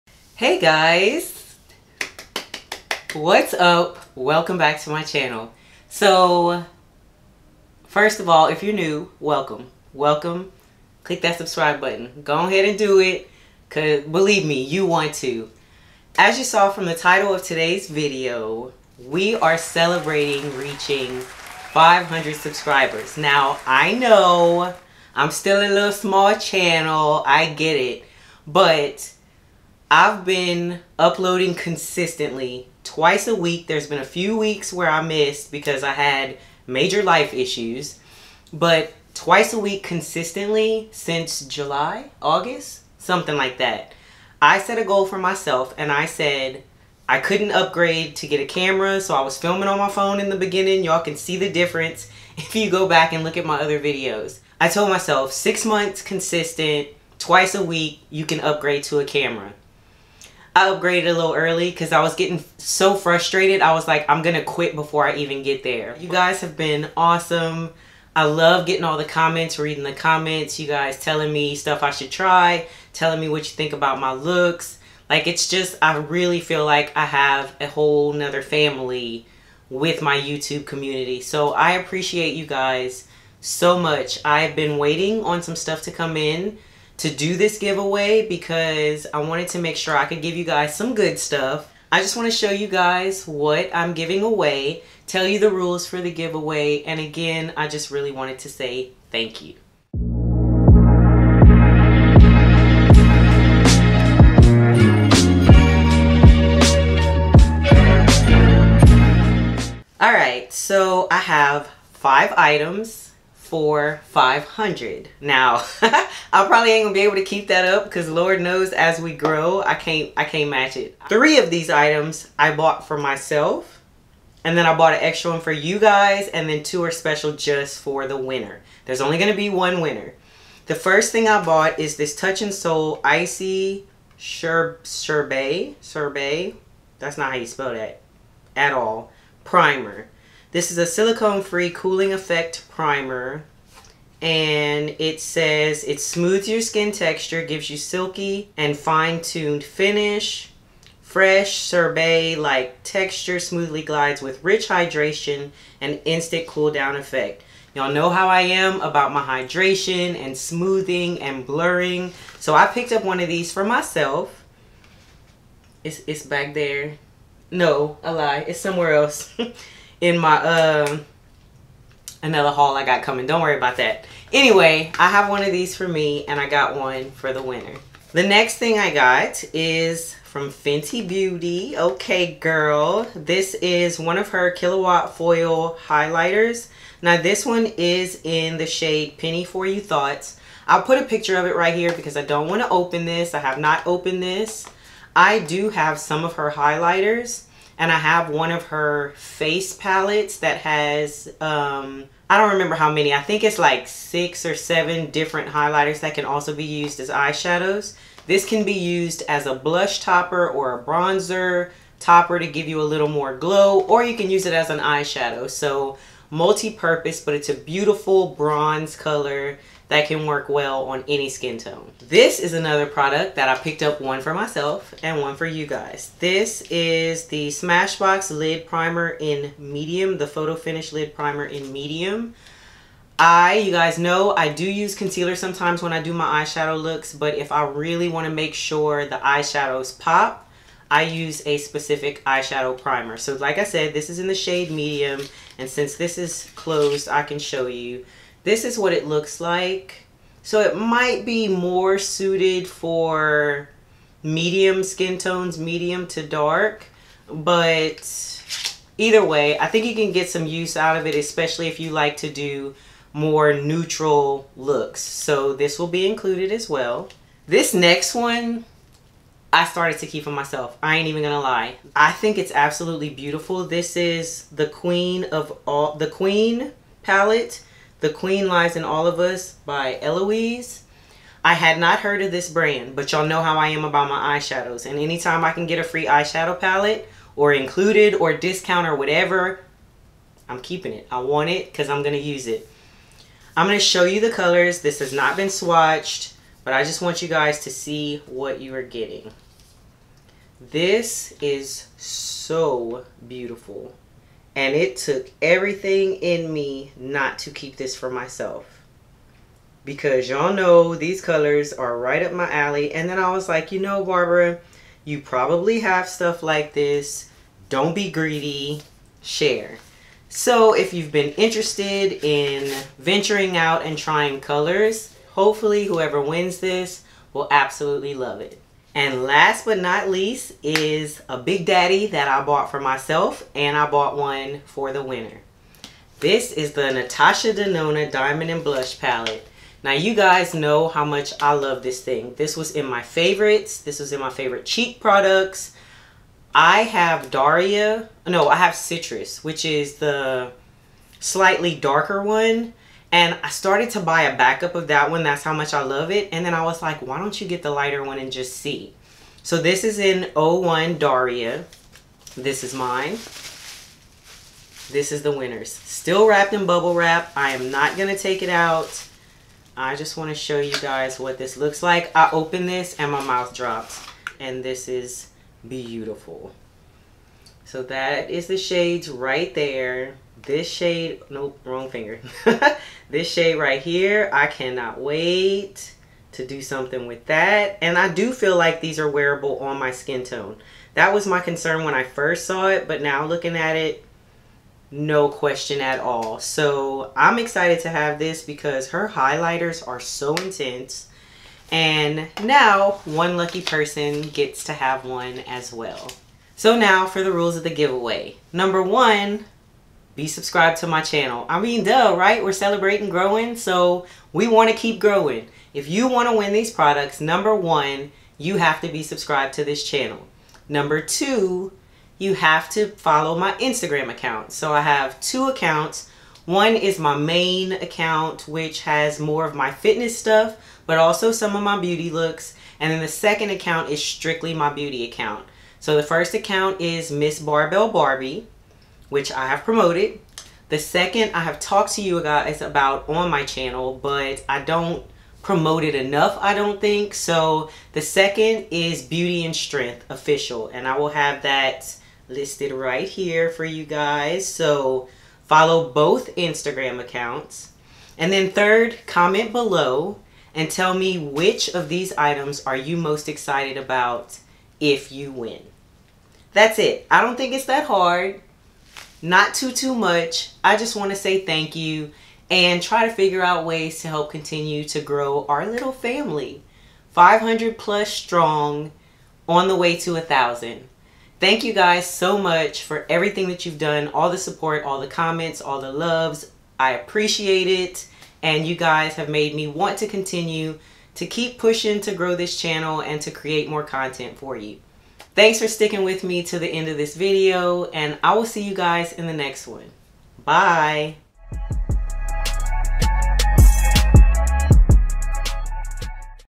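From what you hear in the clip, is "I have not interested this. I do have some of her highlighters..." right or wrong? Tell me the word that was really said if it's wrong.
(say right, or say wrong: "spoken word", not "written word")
wrong: "opened", not "interested".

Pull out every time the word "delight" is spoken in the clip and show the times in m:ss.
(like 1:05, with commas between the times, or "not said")
not said.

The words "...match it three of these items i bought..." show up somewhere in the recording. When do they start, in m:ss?
2:00.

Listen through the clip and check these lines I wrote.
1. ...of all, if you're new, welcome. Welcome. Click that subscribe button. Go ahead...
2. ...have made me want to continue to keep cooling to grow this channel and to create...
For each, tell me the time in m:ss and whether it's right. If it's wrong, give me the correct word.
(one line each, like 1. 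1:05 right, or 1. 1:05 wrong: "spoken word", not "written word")
1. 0:08 right
2. 8:09 wrong: "pushing", not "cooling".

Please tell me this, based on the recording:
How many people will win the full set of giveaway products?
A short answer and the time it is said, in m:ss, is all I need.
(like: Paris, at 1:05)
1, at 2:09.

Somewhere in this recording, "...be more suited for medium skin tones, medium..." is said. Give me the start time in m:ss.
4:11.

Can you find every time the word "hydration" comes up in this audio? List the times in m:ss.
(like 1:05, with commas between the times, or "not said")
2:34, 2:39.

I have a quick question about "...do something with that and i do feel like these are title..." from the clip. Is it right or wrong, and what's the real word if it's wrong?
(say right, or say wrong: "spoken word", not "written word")
wrong: "wearable", not "title".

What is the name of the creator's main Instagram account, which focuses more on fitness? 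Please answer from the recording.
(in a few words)
Miss Barbell Barbie.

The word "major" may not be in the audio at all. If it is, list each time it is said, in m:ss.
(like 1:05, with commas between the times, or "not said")
0:36.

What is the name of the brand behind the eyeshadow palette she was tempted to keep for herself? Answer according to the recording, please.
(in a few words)
Eloise.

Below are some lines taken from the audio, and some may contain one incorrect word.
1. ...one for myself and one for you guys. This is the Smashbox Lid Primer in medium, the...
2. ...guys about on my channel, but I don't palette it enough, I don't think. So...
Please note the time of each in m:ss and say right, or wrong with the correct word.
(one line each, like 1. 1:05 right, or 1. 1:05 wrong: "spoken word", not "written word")
1. 3:43 right
2. 7:22 wrong: "promote", not "palette".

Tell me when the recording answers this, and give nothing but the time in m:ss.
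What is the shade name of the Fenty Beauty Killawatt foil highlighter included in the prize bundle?
3:09.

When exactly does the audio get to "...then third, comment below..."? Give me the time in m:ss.
7:38.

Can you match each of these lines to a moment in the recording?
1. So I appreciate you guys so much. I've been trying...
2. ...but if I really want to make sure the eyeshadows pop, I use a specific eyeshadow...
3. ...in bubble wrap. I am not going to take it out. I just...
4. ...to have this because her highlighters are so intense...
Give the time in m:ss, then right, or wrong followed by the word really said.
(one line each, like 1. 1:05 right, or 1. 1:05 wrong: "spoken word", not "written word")
1. 1:21 wrong: "waiting", not "trying"
2. 3:57 right
3. 6:06 right
4. 6:37 right.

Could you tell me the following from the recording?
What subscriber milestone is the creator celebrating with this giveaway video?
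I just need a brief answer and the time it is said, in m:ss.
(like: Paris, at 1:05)
500, at 0:21.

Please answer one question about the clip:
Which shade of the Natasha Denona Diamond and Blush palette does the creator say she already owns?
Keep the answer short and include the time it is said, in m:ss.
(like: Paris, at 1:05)
Citrus, at 5:48.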